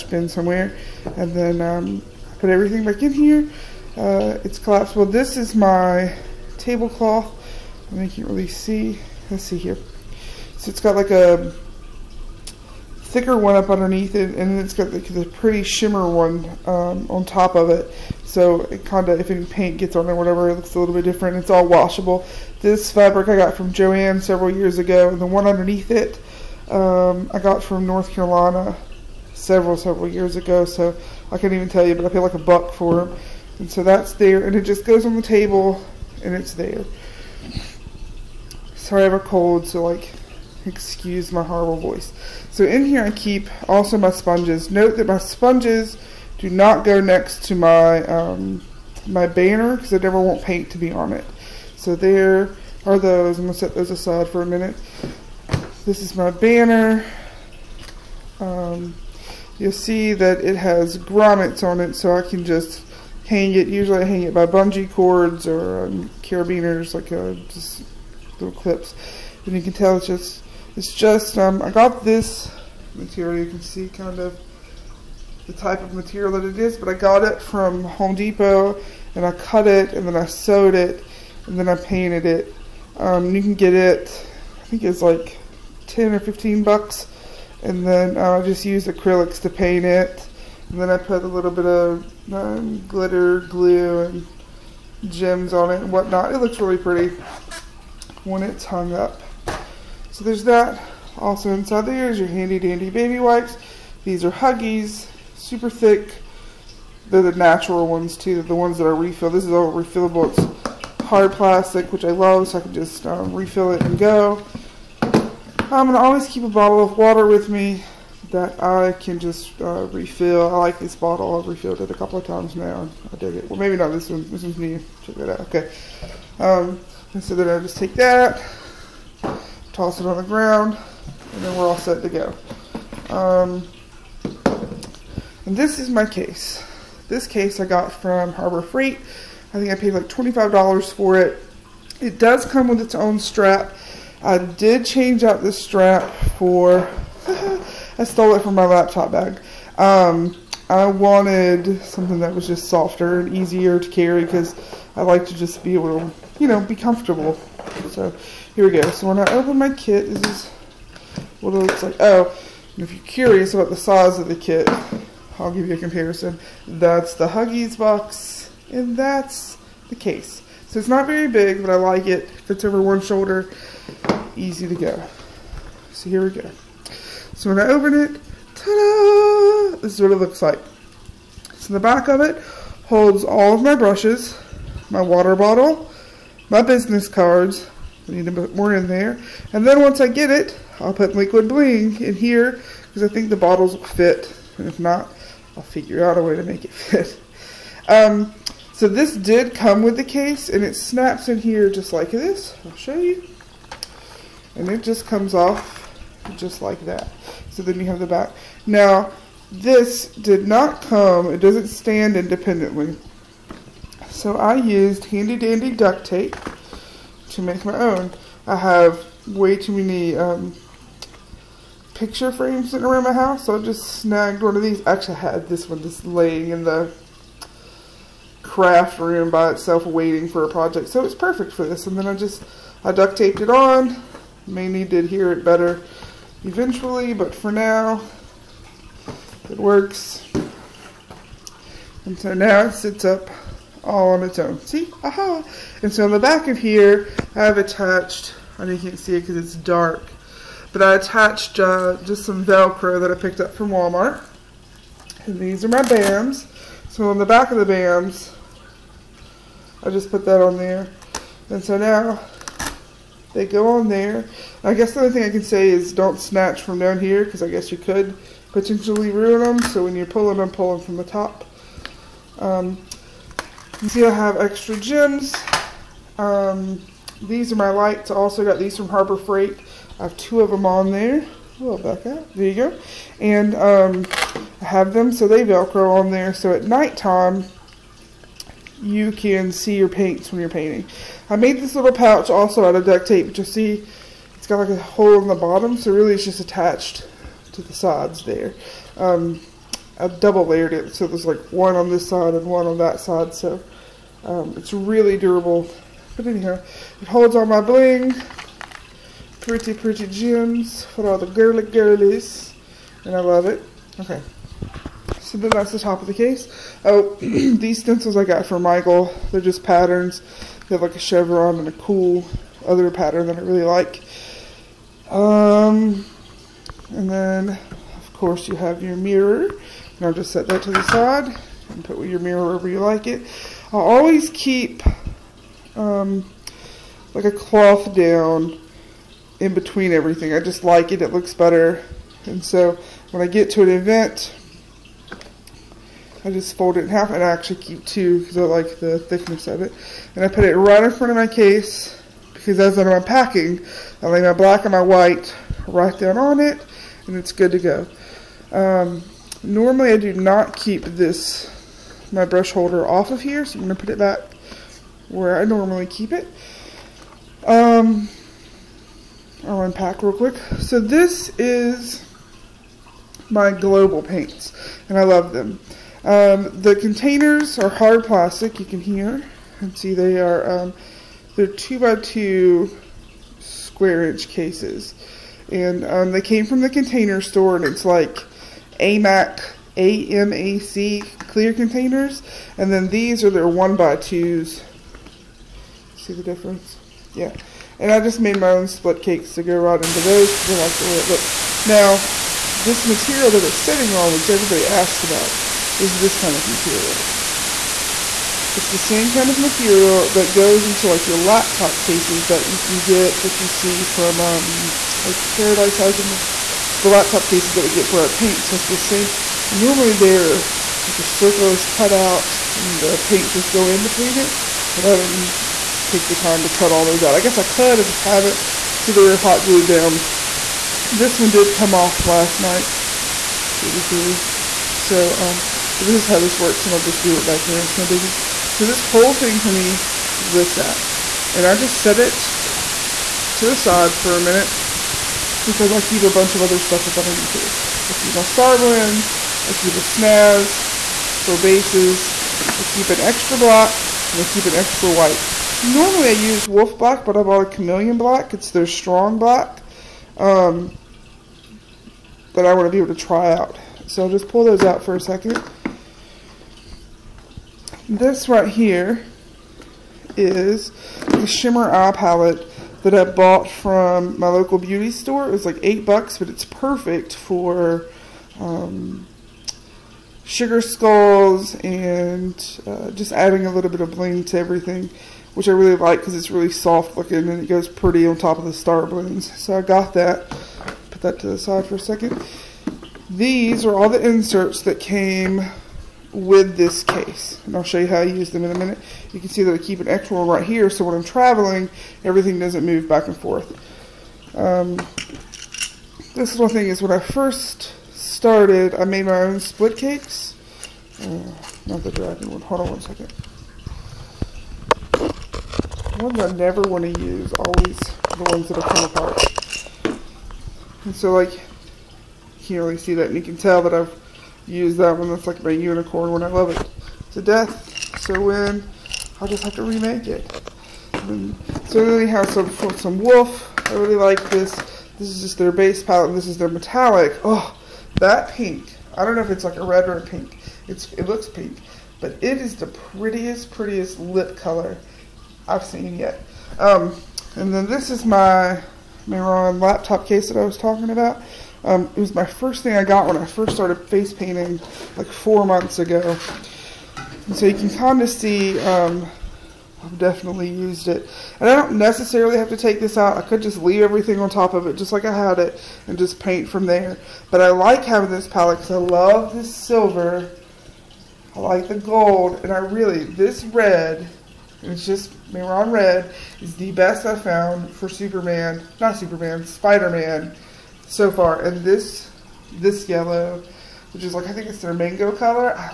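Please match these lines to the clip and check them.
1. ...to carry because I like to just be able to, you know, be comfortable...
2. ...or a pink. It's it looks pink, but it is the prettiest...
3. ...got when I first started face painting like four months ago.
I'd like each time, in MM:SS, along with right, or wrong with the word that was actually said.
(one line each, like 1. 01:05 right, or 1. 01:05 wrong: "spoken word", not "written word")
1. 02:33 right
2. 08:59 right
3. 09:12 right.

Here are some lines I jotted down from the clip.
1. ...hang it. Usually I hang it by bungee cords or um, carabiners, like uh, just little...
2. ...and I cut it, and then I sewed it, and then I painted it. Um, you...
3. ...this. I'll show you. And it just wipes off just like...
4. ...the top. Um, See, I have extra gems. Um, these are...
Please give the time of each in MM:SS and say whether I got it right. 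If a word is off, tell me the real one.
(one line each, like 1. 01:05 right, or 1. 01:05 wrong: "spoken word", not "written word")
1. 01:03 right
2. 01:19 right
3. 03:22 wrong: "comes", not "wipes"
4. 04:30 right.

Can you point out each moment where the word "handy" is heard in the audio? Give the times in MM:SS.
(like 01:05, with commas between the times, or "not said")
01:42, 03:35.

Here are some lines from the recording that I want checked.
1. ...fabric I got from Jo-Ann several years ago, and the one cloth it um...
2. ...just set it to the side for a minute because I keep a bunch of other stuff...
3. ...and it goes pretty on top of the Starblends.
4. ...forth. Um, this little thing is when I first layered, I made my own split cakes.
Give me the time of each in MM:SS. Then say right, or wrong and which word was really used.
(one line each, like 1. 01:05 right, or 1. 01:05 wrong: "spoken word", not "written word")
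1. 00:22 wrong: "underneath", not "cloth"
2. 07:21 right
3. 08:07 right
4. 08:23 wrong: "started", not "layered".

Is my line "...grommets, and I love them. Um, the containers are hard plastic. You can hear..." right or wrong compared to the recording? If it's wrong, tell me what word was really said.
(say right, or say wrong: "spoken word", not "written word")
wrong: "paints", not "grommets".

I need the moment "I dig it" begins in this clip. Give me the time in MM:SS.
02:03.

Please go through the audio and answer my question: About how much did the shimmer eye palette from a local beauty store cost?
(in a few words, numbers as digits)
8 dollars.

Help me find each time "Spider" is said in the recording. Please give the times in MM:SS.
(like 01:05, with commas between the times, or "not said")
09:39.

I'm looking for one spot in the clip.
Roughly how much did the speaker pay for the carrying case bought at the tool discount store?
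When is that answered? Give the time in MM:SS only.
02:20.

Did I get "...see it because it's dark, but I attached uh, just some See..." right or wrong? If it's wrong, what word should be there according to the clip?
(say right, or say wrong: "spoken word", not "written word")
wrong: "Velcro", not "See".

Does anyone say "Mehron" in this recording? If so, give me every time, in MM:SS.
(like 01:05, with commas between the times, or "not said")
09:09, 09:35.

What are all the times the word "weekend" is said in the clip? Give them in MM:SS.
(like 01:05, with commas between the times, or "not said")
not said.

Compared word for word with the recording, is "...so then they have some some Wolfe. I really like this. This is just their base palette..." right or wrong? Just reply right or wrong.
right.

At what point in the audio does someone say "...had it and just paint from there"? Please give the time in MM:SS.
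09:25.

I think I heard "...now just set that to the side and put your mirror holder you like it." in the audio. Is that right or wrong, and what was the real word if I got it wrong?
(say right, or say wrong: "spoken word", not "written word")
wrong: "wherever", not "holder".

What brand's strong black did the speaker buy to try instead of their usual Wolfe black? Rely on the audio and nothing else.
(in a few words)
Cameleon.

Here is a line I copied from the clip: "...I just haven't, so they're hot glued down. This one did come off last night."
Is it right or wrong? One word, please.
right.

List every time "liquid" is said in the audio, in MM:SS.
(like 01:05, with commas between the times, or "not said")
03:11.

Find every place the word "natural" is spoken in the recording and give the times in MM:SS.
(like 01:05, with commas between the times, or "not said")
01:47.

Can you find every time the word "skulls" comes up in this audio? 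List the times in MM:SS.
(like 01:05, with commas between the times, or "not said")
08:00.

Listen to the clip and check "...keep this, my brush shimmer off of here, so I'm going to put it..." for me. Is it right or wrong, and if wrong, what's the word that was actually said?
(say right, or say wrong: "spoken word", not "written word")
wrong: "holder", not "shimmer".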